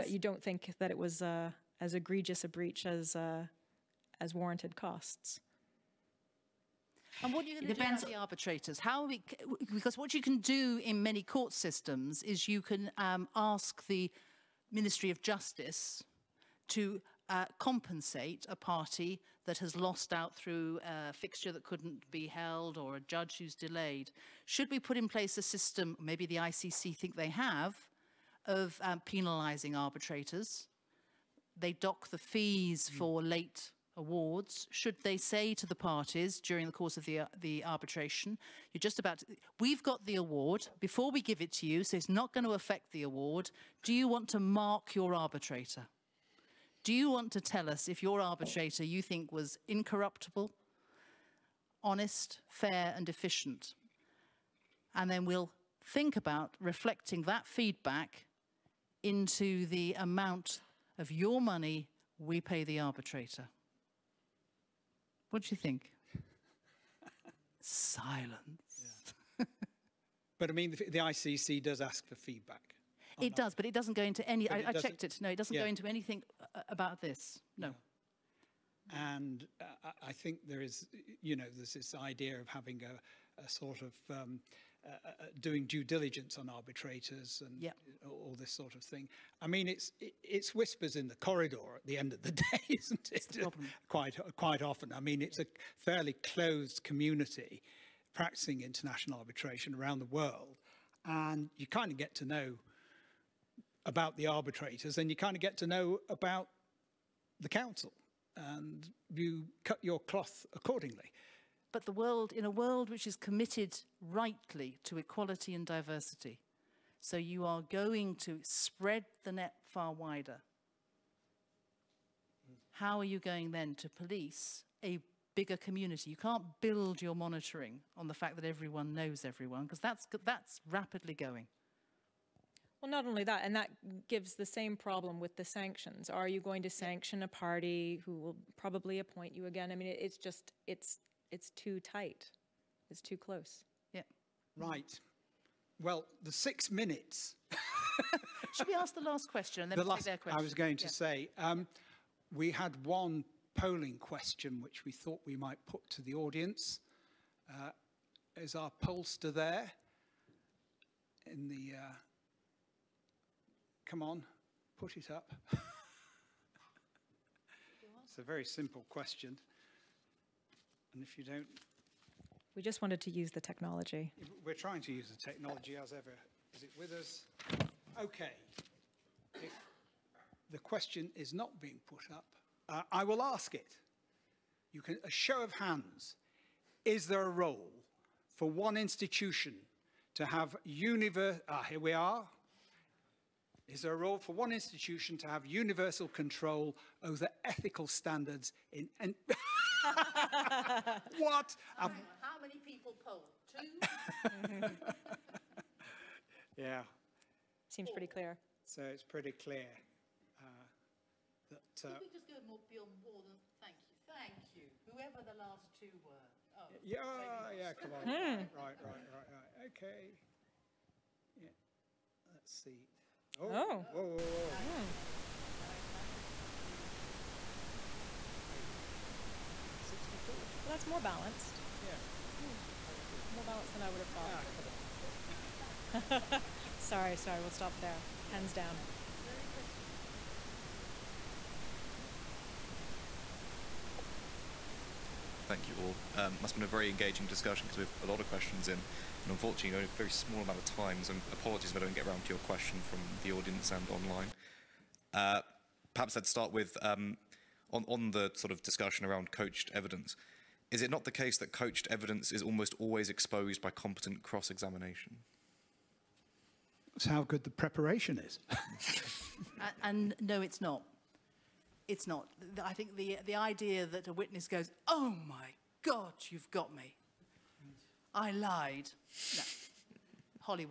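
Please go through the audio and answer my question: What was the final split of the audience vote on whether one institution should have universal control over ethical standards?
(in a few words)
60 40.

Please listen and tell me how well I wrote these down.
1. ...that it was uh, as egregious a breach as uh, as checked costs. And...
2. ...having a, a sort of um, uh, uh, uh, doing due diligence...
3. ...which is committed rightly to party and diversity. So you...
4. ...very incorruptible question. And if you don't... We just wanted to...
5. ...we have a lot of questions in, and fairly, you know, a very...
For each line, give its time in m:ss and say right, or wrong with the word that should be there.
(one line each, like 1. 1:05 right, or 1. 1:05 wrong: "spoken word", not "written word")
1. 0:00 wrong: "warranted", not "checked"
2. 1:22 right
3. 1:52 wrong: "equality", not "party"
4. 2:48 wrong: "simple", not "incorruptible"
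5. 4:07 wrong: "unfortunately", not "fairly".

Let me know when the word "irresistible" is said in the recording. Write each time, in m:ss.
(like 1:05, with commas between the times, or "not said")
3:46.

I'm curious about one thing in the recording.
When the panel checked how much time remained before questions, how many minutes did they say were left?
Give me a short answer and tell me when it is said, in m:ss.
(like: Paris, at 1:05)
6, at 2:26.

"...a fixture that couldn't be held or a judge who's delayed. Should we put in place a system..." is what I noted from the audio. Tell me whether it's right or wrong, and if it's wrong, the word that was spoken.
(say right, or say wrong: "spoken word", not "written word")
right.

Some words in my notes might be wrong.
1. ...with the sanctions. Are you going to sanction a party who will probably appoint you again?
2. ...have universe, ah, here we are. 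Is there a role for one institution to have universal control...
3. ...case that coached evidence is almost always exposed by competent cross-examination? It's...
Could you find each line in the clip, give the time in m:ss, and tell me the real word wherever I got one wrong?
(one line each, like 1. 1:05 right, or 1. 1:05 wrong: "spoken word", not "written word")
1. 2:15 right
2. 3:10 right
3. 4:21 right.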